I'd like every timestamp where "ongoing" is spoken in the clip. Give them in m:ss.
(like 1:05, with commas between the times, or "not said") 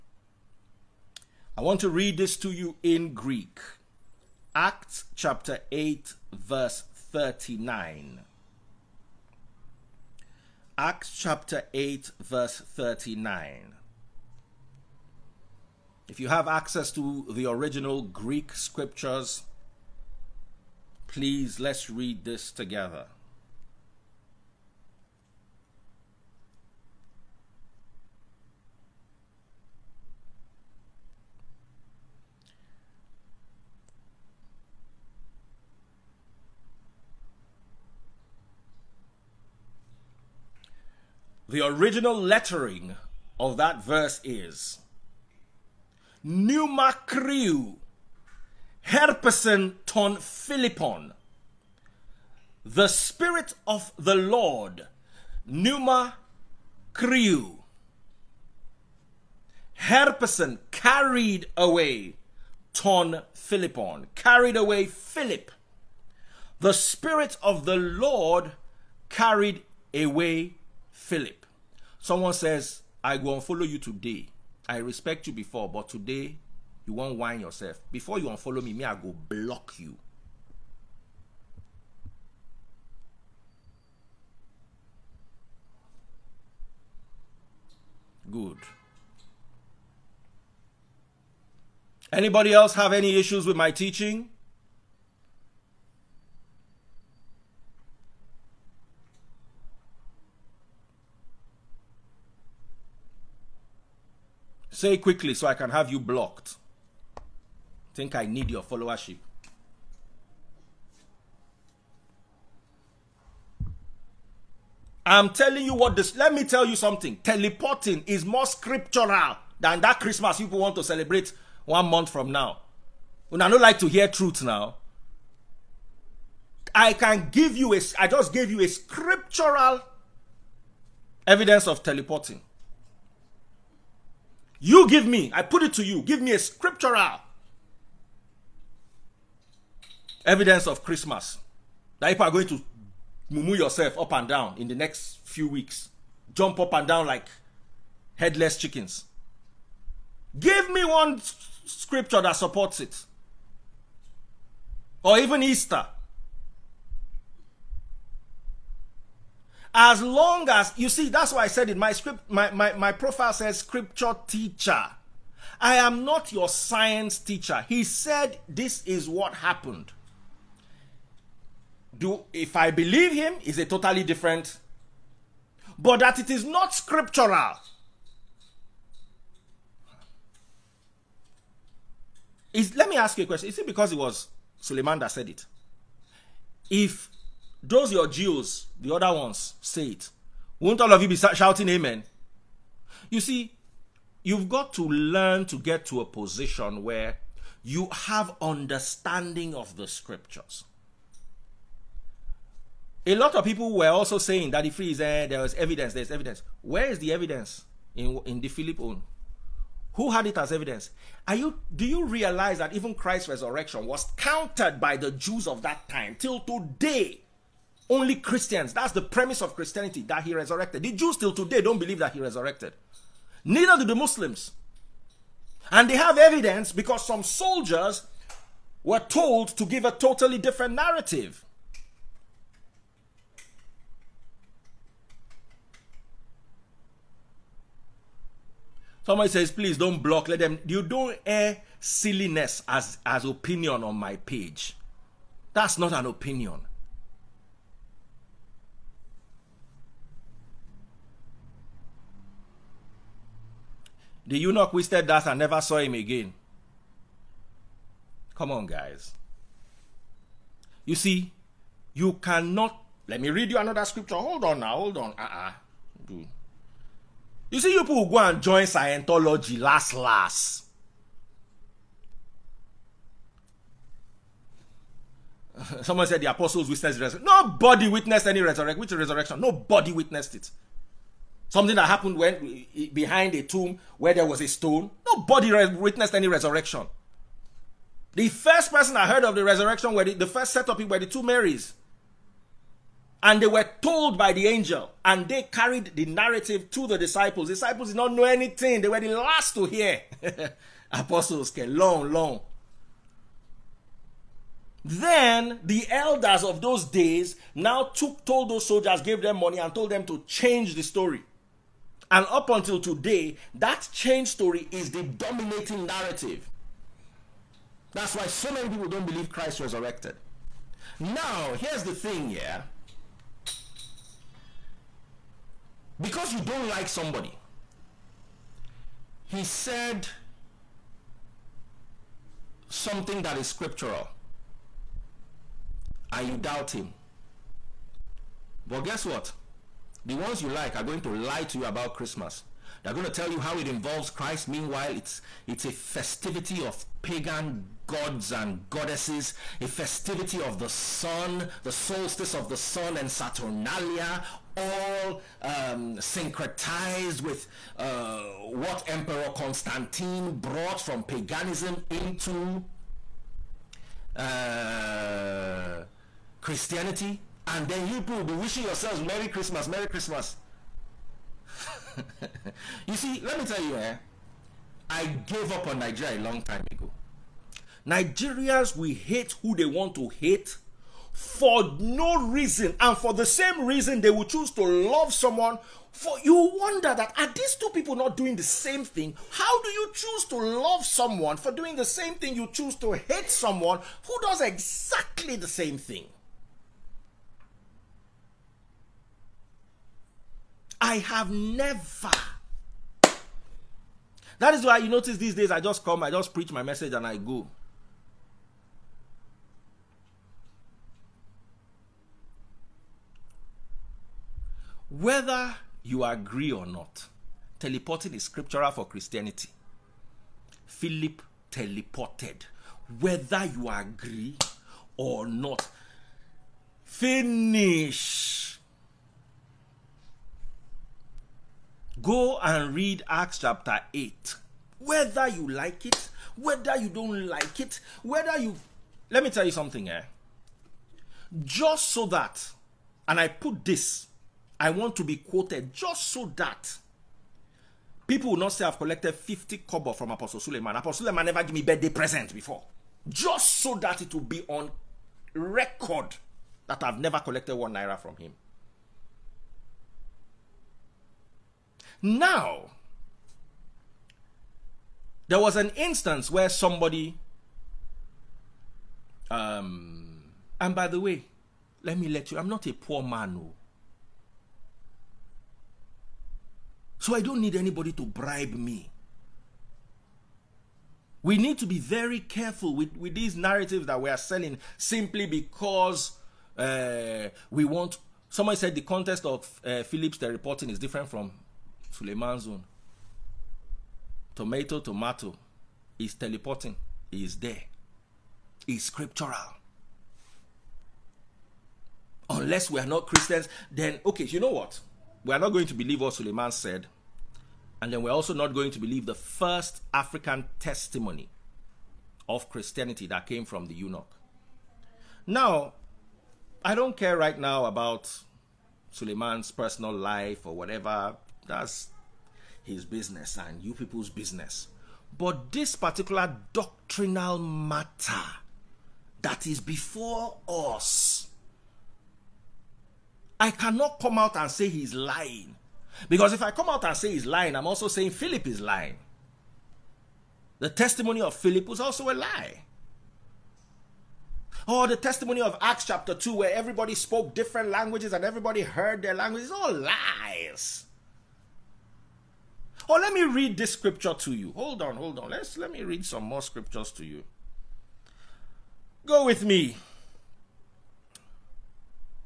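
not said.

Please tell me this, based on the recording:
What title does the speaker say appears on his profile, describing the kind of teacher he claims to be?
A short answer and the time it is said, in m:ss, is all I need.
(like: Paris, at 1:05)
Scripture teacher, at 2:43.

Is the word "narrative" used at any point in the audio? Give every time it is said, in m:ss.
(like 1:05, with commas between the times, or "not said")
3:50, 4:56, 5:15, 8:03.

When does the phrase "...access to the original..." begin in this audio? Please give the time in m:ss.
0:16.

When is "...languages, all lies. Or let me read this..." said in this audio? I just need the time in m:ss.
9:09.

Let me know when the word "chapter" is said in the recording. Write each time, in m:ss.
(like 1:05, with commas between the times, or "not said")
0:05, 0:11, 7:13, 9:05.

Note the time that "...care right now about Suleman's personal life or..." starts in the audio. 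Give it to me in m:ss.
8:36.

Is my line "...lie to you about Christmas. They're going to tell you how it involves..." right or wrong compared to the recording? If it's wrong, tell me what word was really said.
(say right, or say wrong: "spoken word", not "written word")
right.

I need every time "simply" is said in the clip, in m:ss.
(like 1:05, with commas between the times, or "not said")
8:04.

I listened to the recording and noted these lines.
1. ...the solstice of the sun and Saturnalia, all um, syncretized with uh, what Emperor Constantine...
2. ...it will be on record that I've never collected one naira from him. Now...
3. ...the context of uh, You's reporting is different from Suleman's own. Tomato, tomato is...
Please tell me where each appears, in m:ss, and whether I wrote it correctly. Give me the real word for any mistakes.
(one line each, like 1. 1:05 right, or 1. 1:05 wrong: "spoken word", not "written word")
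1. 5:51 right
2. 7:34 right
3. 8:08 wrong: "Philip", not "You".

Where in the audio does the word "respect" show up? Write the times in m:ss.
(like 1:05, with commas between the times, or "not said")
1:14.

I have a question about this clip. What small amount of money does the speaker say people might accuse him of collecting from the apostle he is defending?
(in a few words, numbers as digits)
50 kobo.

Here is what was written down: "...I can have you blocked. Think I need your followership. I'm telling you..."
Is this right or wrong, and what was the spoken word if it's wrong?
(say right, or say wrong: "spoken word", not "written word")
right.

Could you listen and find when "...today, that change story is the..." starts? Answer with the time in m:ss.
5:12.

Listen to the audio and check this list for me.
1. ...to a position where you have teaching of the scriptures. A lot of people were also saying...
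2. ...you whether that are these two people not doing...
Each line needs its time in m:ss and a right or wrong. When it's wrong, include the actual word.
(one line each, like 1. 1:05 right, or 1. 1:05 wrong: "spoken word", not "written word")
1. 3:15 wrong: "understanding", not "teaching"
2. 6:26 wrong: "wonder", not "whether".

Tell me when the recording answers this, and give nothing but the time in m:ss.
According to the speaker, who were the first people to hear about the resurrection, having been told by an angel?
4:51.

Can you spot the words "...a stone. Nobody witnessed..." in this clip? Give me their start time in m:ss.
4:44.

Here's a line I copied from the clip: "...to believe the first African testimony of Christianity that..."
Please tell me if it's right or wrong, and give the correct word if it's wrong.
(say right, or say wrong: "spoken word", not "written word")
right.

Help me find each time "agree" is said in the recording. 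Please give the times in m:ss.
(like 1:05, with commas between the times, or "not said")
6:56, 7:03.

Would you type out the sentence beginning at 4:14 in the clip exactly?
The eunuch wasted that and never saw him again.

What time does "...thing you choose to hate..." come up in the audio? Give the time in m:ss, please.
6:32.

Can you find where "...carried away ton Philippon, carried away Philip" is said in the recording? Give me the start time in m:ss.
1:00.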